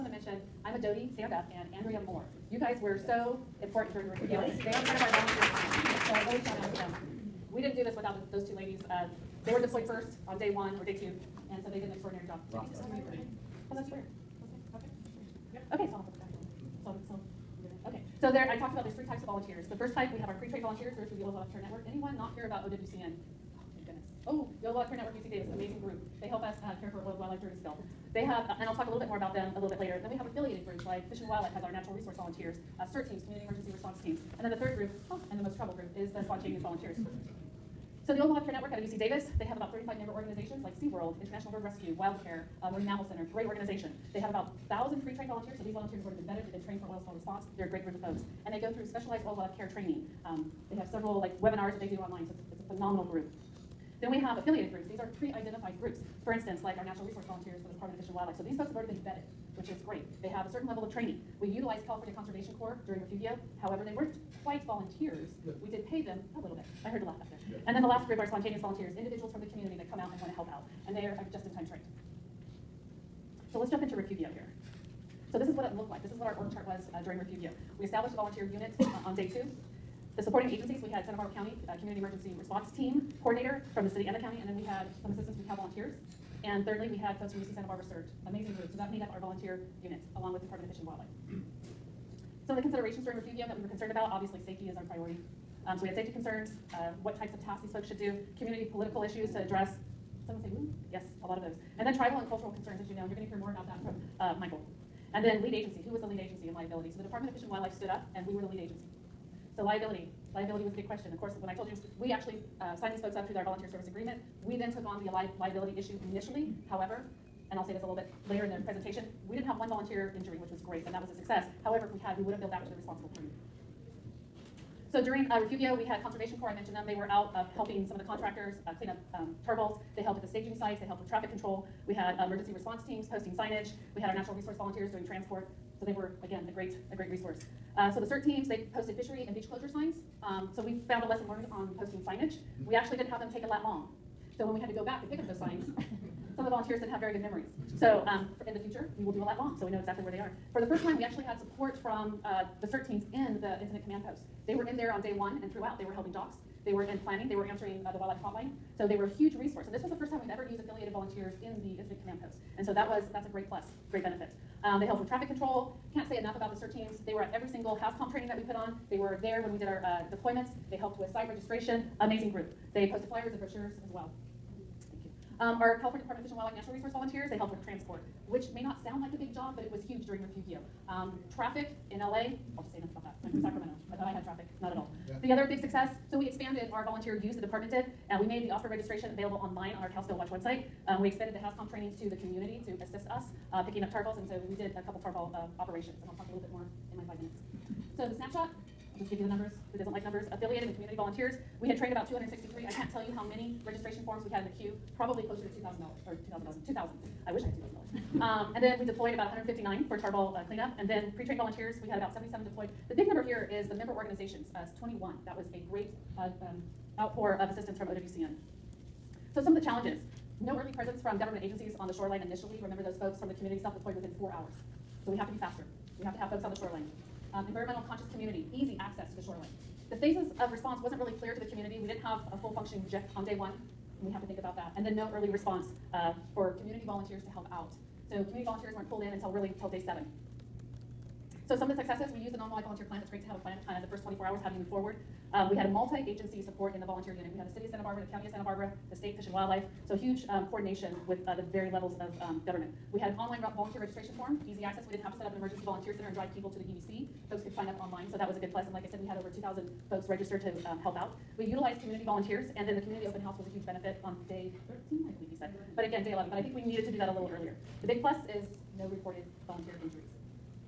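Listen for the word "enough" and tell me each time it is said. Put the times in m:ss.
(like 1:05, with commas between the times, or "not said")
2:46, 3:02.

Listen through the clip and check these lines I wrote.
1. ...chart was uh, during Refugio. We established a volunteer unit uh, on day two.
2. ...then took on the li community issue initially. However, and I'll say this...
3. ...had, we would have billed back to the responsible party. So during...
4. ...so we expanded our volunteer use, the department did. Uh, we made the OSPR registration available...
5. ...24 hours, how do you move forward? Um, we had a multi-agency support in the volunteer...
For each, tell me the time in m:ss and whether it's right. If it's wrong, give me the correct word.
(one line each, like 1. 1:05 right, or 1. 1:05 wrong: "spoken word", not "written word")
1. 1:16 right
2. 1:54 wrong: "liability", not "community"
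3. 2:02 right
4. 3:06 right
5. 4:04 right.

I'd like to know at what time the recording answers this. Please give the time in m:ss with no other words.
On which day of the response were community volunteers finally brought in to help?
3:59.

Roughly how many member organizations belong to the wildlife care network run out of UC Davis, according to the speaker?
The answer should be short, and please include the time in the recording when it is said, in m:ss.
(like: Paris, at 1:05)
35, at 0:39.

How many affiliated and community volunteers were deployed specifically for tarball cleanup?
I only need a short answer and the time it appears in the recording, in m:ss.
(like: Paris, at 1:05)
159, at 3:29.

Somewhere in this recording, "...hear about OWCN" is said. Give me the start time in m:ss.
0:22.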